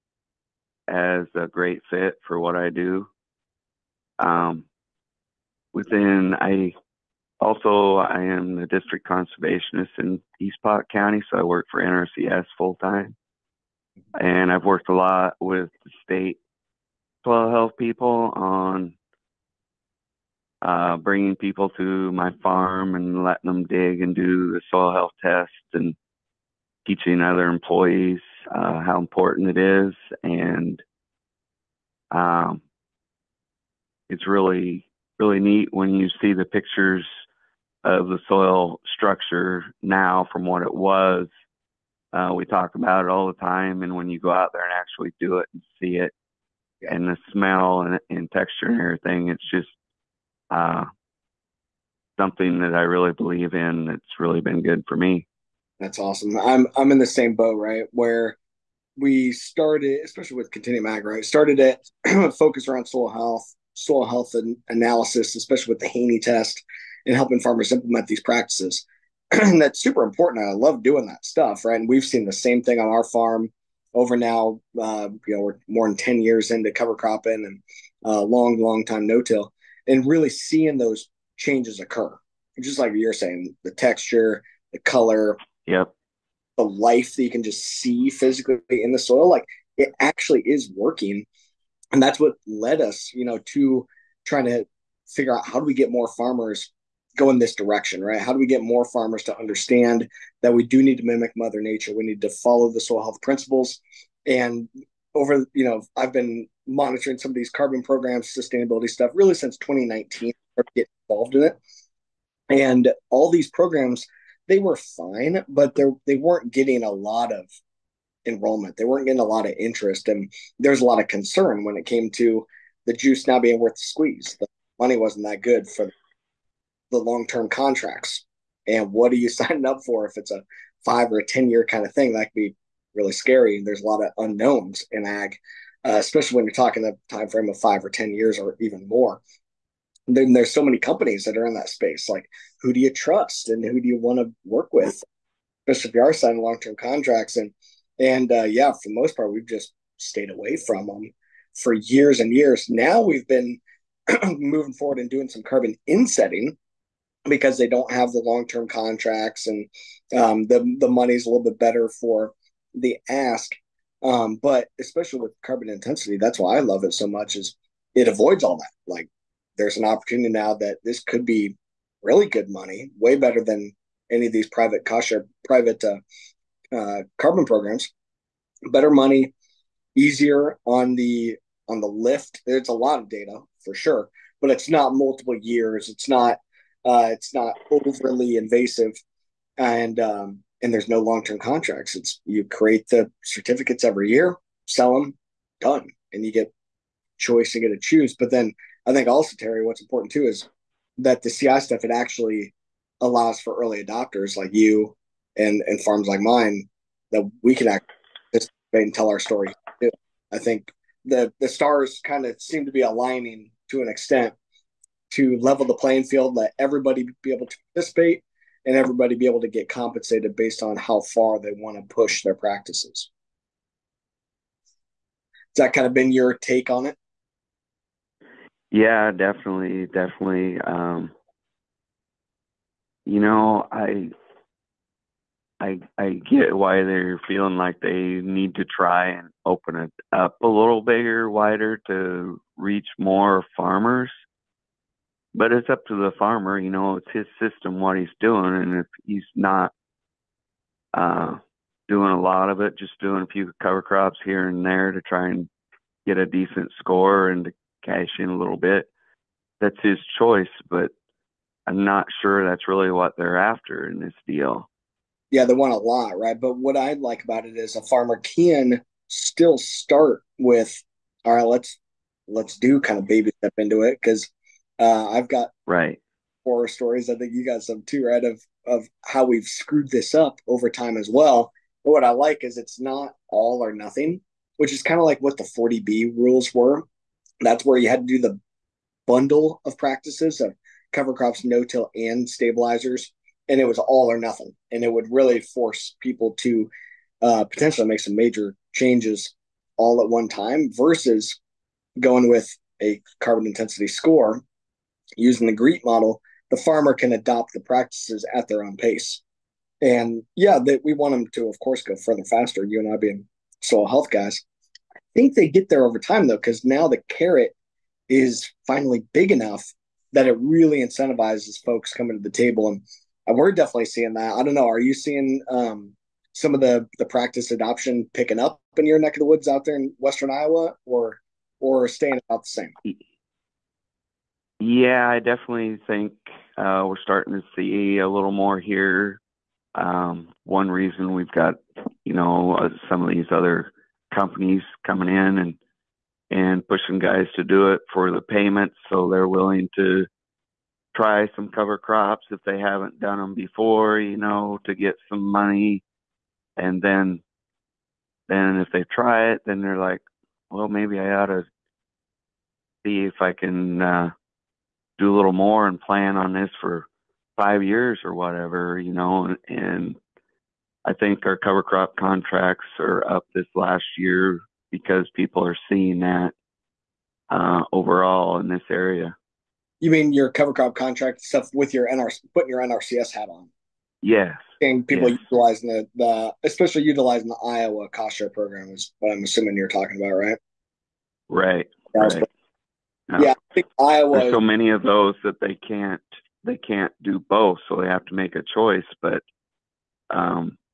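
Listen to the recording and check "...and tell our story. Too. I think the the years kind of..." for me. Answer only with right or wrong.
wrong.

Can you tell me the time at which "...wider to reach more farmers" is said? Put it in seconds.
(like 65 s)
241 s.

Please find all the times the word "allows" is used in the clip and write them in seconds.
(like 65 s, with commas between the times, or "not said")
203 s.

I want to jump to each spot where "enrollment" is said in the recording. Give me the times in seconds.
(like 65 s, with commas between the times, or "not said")
118 s.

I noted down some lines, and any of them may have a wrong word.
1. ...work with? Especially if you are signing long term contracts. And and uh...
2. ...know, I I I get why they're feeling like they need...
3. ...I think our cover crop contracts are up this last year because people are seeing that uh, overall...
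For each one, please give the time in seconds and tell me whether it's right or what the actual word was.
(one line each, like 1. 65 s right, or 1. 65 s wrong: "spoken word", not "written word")
1. 144 s right
2. 233 s right
3. 370 s right.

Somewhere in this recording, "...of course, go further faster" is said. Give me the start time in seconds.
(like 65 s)
311 s.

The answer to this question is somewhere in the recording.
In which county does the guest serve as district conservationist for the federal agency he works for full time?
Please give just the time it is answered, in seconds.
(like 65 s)
10 s.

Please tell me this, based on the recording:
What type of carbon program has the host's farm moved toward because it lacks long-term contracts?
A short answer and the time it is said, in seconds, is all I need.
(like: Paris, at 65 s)
carbon insetting, at 155 s.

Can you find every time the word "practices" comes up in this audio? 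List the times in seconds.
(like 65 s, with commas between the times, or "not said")
68 s, 222 s, 289 s, 307 s, 327 s.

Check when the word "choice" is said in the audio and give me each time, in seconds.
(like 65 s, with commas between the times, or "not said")
197 s, 260 s, 398 s.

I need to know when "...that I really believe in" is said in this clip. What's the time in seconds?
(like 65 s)
52 s.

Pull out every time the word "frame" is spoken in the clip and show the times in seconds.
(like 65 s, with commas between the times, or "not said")
137 s.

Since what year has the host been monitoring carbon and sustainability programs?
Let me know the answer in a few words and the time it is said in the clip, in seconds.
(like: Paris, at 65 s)
2019, at 109 s.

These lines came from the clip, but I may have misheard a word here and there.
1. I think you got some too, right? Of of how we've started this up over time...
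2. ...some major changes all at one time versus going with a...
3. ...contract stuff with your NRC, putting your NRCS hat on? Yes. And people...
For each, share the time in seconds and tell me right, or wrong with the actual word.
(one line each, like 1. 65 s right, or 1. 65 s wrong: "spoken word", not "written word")
1. 277 s wrong: "screwed", not "started"
2. 297 s right
3. 380 s right.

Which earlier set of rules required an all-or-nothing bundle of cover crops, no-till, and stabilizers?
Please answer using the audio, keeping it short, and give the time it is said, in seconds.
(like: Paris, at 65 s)
40B rules, at 285 s.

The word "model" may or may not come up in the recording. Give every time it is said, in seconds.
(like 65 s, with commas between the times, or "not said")
305 s.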